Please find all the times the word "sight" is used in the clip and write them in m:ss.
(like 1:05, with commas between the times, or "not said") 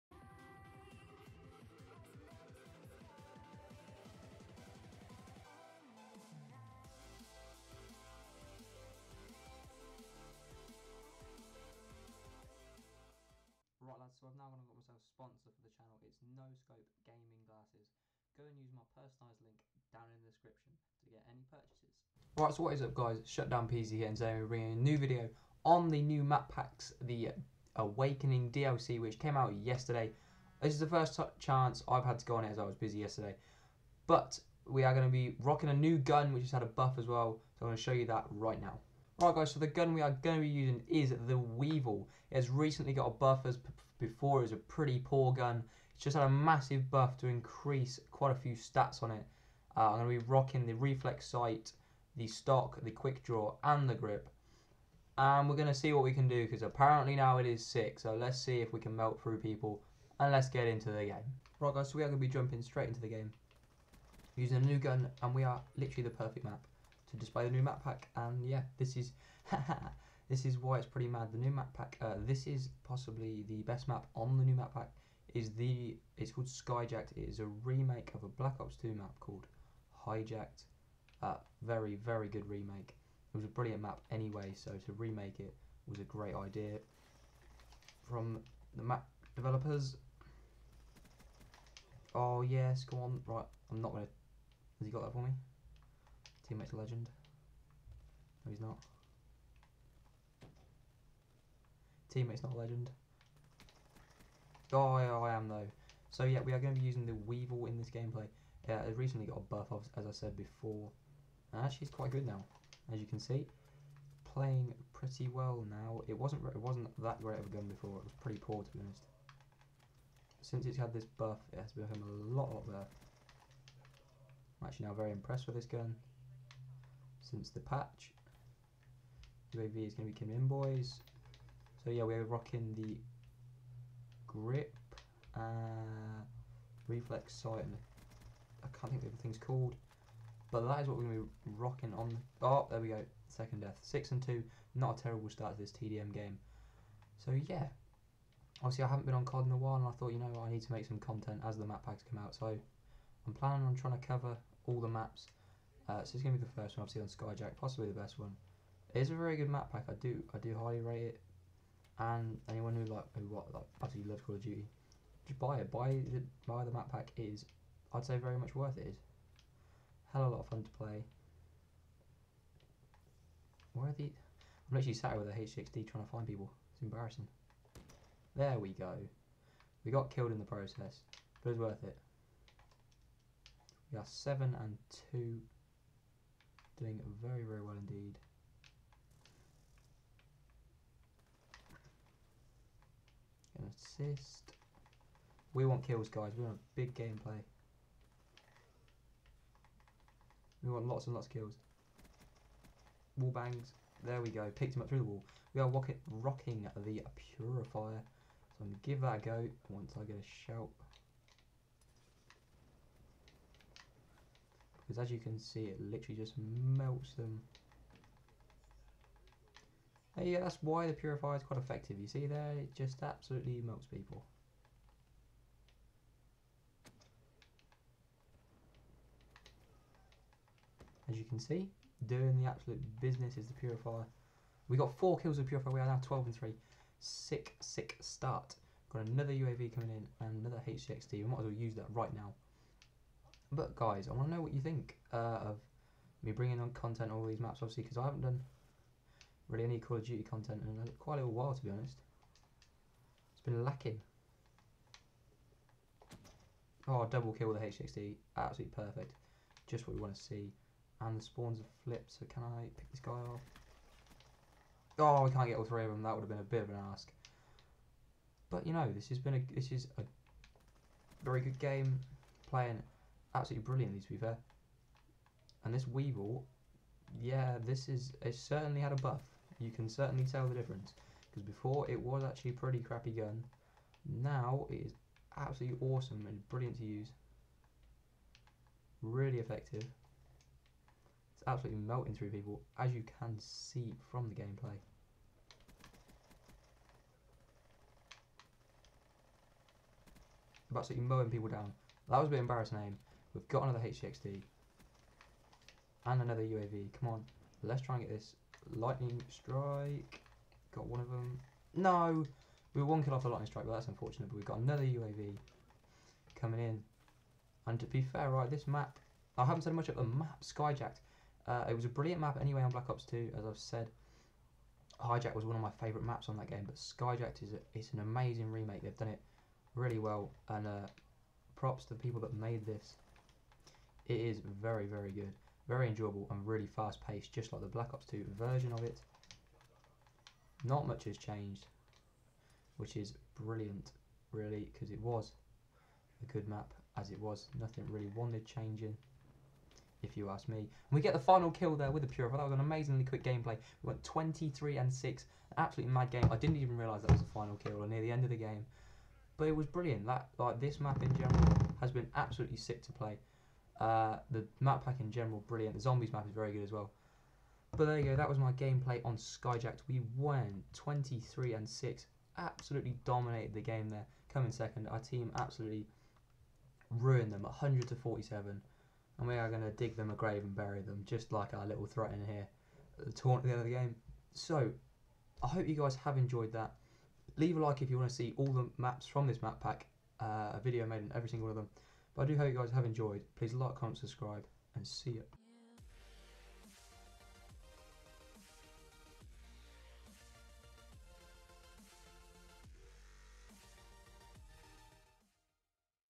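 0:51, 2:17.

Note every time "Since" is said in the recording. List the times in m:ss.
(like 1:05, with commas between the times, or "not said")
2:00, 2:07.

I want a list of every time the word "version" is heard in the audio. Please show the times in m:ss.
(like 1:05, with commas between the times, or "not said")
5:38.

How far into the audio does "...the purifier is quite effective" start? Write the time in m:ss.
3:40.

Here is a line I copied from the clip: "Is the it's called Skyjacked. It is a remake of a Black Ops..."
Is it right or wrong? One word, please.
right.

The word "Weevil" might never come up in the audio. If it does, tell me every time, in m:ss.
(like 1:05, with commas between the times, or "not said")
0:41, 1:47, 4:35.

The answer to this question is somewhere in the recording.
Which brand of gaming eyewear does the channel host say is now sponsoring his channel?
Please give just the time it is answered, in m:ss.
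0:16.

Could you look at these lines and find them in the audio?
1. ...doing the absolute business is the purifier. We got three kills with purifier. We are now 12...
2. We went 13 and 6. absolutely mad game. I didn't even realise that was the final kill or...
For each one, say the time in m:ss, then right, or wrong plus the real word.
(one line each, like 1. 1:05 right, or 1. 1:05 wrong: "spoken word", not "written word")
1. 3:52 wrong: "four", not "three"
2. 5:53 wrong: "23", not "13".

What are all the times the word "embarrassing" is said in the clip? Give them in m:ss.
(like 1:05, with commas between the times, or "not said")
2:56, 5:02.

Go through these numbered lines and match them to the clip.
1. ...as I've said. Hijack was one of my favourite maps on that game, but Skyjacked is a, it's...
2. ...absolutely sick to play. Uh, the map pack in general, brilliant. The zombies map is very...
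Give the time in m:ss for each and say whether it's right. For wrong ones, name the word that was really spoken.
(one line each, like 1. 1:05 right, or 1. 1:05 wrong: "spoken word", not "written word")
1. 5:23 right
2. 6:02 right.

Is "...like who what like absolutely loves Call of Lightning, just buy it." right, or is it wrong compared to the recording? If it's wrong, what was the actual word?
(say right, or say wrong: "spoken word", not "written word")
wrong: "Duty", not "Lightning".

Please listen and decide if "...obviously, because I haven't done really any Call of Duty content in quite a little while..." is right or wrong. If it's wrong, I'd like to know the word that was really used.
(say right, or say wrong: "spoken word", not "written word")
right.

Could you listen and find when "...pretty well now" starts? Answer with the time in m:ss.
1:54.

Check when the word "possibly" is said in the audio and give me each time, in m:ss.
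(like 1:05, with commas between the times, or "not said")
1:12, 2:37.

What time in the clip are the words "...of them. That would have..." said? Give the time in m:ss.
4:25.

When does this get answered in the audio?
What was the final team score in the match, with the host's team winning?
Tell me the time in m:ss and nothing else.
6:17.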